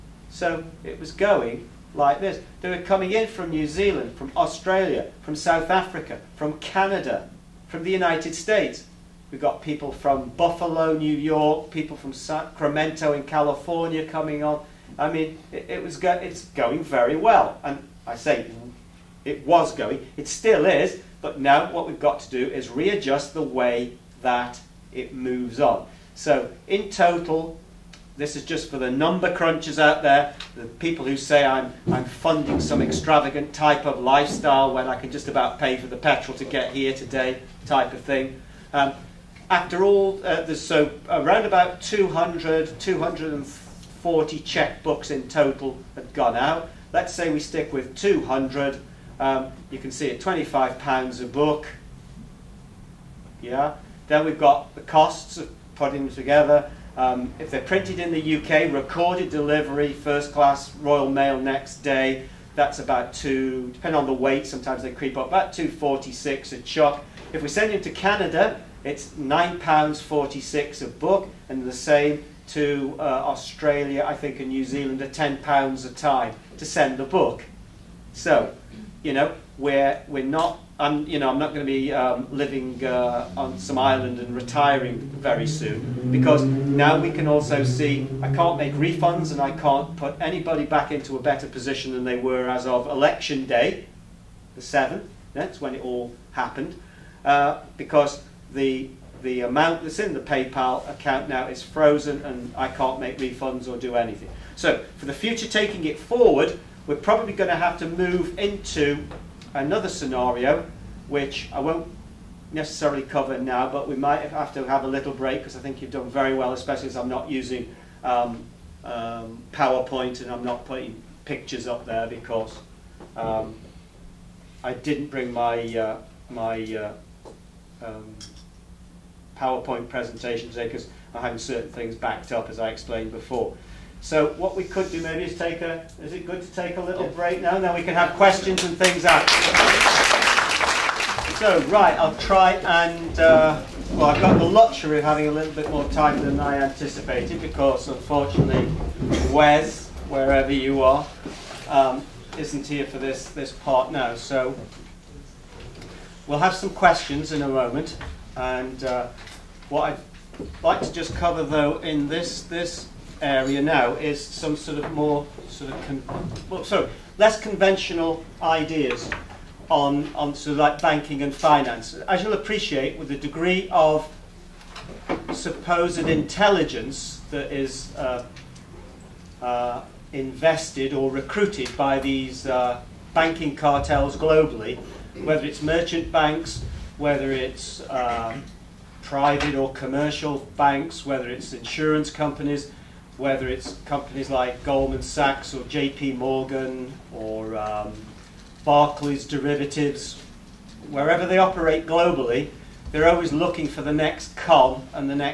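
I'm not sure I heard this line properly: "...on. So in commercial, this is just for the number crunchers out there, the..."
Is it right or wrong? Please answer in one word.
wrong.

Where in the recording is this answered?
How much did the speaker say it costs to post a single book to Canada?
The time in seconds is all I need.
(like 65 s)
69 s.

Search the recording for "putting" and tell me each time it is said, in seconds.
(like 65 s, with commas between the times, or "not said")
55 s, 120 s.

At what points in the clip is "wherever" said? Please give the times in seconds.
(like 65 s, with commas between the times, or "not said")
150 s, 200 s.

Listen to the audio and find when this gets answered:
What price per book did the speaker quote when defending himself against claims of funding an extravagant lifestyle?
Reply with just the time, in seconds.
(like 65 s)
50 s.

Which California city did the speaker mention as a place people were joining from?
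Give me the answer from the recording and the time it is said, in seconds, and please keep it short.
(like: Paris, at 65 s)
Sacramento, at 12 s.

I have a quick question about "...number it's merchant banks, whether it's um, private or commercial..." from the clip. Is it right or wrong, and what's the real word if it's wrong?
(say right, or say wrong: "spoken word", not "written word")
wrong: "whether", not "number".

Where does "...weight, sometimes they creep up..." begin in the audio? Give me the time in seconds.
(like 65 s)
64 s.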